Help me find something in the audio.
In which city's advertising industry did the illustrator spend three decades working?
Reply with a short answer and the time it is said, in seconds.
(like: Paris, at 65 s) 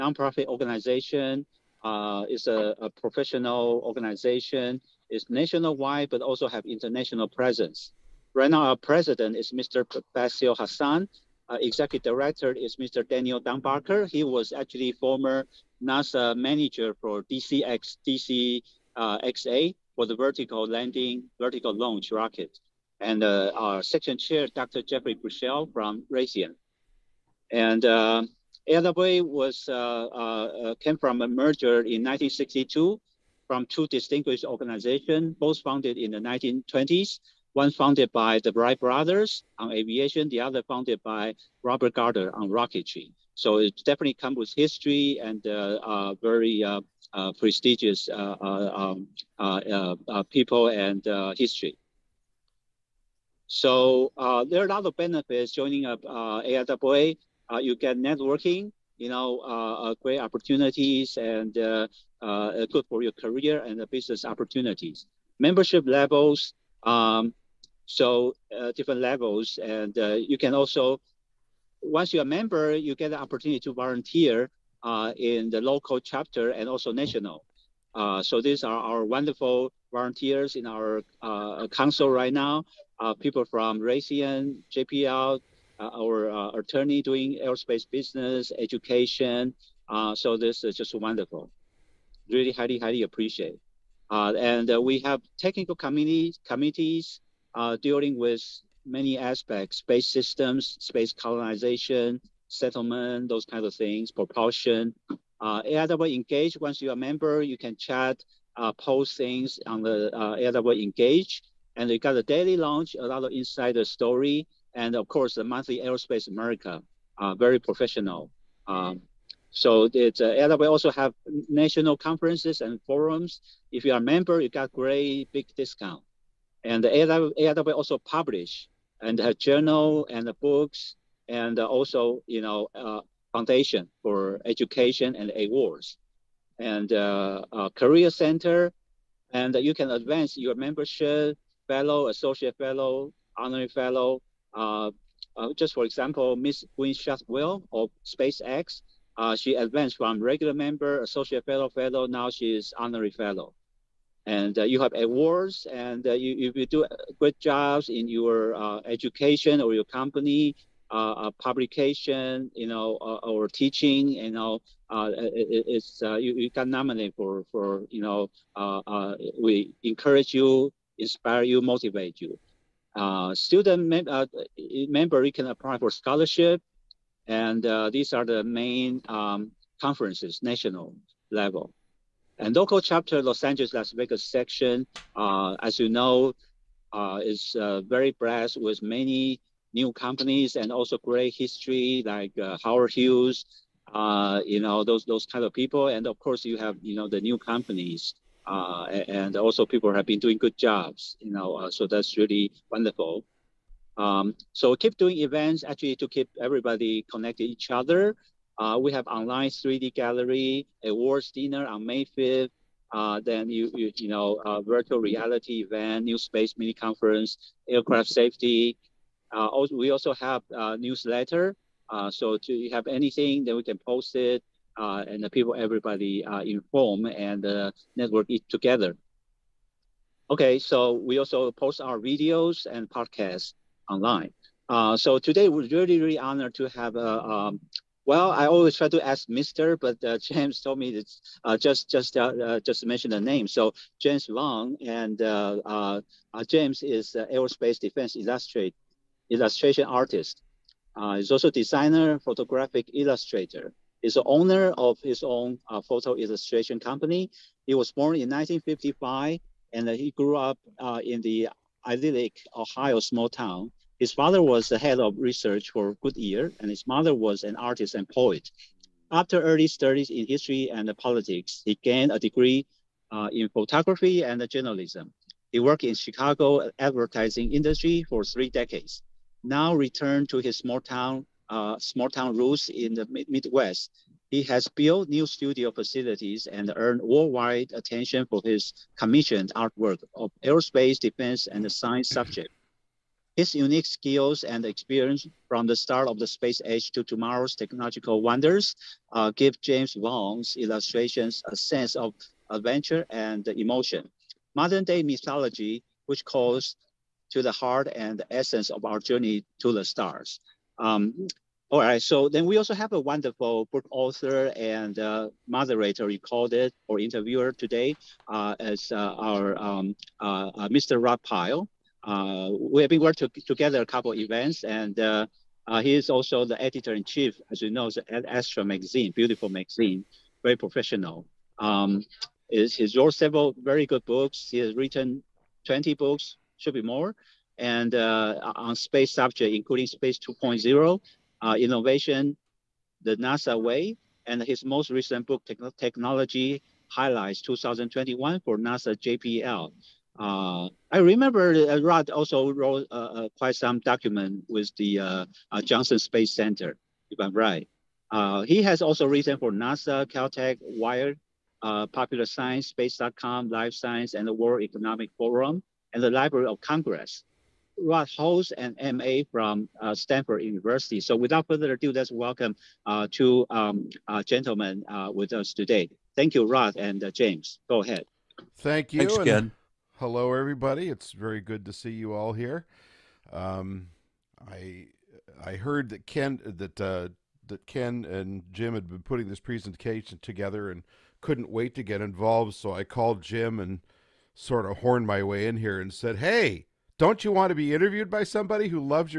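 Chicago, at 275 s.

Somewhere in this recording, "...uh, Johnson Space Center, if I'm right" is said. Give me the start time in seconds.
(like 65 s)
355 s.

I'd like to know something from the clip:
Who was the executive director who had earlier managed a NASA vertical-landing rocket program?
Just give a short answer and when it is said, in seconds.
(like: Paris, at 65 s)
Daniel Dunbarker, at 13 s.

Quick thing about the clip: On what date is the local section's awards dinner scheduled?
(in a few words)
May 5th.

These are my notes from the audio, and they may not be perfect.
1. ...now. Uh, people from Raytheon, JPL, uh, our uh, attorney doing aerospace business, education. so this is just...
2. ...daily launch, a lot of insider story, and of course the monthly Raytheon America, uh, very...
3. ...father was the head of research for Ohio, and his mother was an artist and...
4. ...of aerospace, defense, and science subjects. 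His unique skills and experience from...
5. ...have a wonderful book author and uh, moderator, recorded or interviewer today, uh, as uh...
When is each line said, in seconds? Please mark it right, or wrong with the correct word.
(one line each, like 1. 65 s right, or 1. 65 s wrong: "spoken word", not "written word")
1. 82 s right
2. 112 s wrong: "Aerospace", not "Raytheon"
3. 264 s wrong: "Goodyear", not "Ohio"
4. 290 s right
5. 312 s right.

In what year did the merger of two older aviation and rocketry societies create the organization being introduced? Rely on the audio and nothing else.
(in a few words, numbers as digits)
1962.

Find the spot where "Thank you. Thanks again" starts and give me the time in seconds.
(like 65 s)
378 s.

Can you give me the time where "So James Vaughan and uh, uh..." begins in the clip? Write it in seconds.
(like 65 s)
243 s.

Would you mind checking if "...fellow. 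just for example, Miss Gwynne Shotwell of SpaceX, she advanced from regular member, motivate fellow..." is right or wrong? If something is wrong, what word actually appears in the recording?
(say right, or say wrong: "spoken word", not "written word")
wrong: "associate", not "motivate".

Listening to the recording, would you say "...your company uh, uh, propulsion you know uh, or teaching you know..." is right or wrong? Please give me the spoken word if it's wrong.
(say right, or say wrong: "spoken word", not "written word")
wrong: "publication", not "propulsion".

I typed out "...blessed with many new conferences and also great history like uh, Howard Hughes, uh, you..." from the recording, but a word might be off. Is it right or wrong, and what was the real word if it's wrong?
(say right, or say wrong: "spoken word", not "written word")
wrong: "companies", not "conferences".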